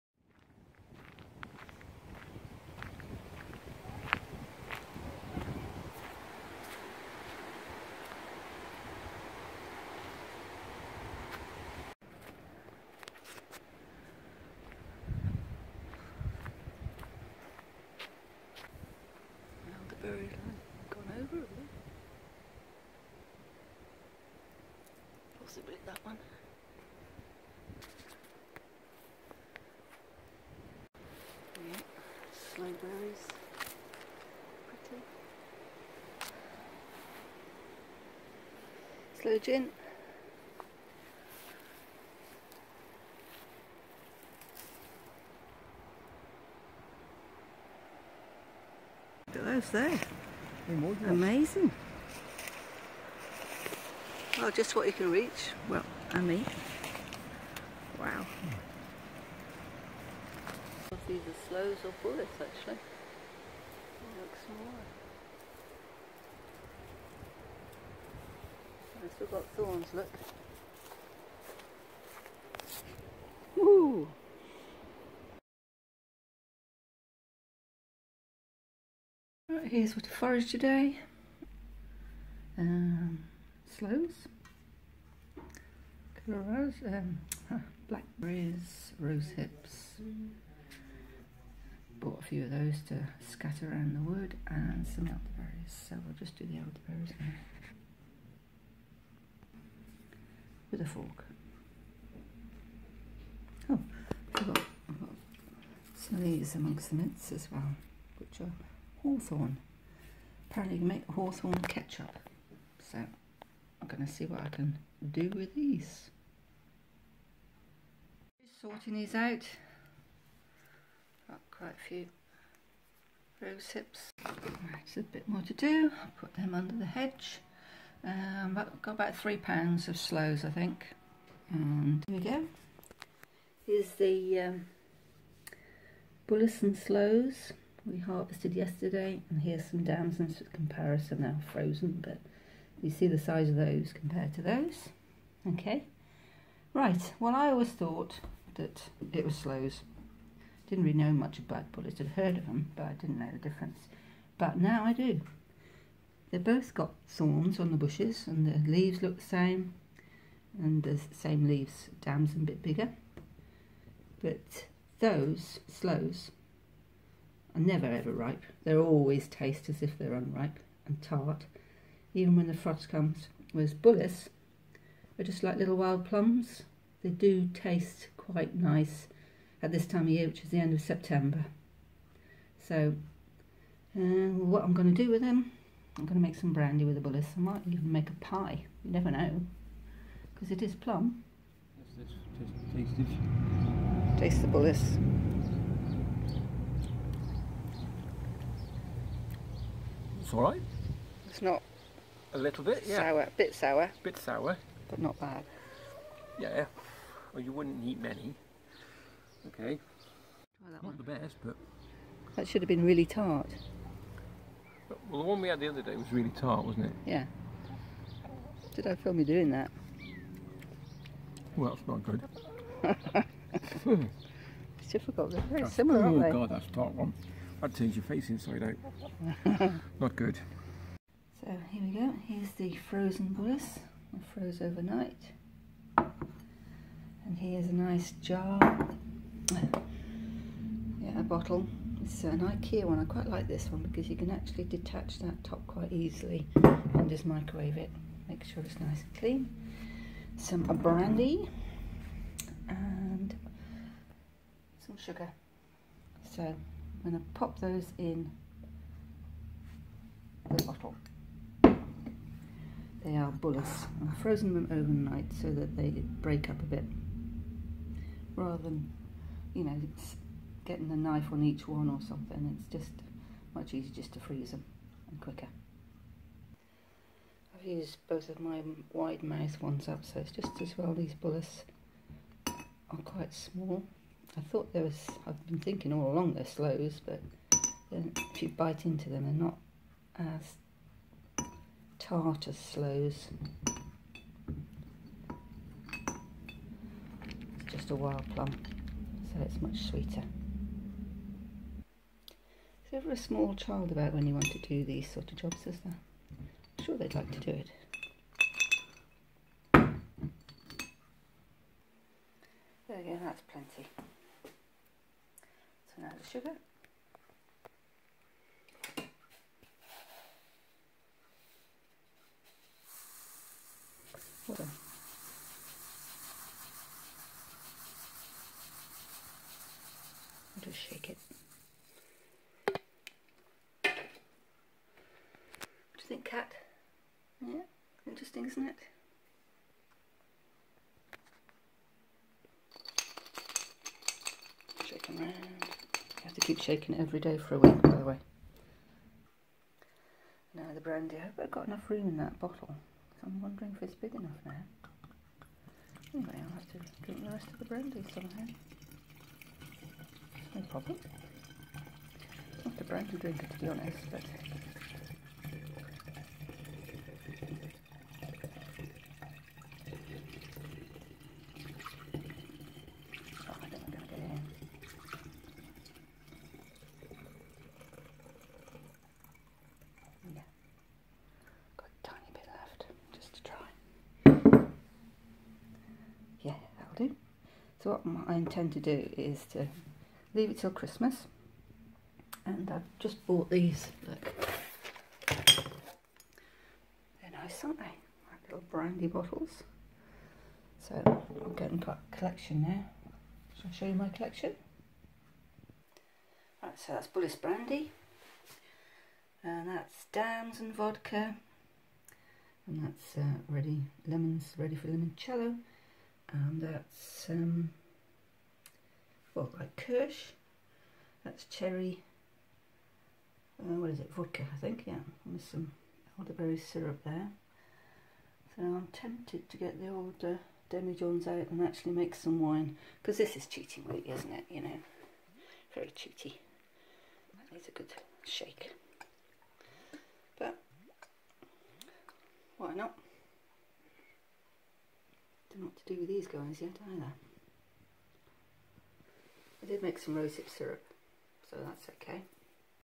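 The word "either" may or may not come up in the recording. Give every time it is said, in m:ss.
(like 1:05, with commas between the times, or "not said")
1:01, 7:26.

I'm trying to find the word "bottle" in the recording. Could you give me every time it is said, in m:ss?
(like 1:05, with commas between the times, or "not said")
4:01, 4:20, 5:52, 6:39.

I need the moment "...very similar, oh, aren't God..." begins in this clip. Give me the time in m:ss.
3:45.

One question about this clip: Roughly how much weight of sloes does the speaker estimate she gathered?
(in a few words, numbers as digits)
3 pounds.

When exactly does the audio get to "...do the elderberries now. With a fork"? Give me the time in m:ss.
1:36.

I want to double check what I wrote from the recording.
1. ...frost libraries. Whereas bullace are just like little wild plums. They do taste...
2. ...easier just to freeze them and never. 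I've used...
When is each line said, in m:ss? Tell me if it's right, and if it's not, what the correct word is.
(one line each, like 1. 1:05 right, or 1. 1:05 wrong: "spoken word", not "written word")
1. 2:52 wrong: "comes", not "libraries"
2. 4:33 wrong: "quicker", not "never".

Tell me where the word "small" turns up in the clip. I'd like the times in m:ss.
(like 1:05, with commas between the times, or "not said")
4:43, 5:03.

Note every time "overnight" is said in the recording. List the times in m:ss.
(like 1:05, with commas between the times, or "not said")
3:54, 4:24.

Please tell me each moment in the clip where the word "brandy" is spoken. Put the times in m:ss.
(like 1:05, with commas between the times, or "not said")
3:06, 4:10, 5:50, 5:57, 6:38, 6:47.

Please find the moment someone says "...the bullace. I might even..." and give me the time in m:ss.
3:07.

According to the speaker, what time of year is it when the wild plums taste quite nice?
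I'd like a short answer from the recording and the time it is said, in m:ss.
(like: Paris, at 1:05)
End of September, at 3:00.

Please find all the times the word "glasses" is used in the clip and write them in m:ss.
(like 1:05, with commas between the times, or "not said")
not said.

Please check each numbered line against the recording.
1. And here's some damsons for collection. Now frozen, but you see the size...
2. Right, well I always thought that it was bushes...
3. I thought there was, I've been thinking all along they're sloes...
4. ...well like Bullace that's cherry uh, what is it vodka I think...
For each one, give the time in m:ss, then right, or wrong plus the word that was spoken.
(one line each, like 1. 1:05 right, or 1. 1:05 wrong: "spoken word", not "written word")
1. 2:19 wrong: "comparison", not "collection"
2. 2:26 wrong: "sloes", not "bushes"
3. 4:44 right
4. 6:59 wrong: "Kirsch", not "Bullace".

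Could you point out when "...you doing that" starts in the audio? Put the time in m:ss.
3:39.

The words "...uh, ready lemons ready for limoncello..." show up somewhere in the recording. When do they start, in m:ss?
6:53.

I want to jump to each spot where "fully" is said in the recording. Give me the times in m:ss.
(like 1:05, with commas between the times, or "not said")
not said.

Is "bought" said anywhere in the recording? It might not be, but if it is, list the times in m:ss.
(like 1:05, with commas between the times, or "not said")
1:32, 6:33.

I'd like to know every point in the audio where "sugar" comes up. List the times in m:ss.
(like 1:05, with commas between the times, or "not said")
4:14, 5:16.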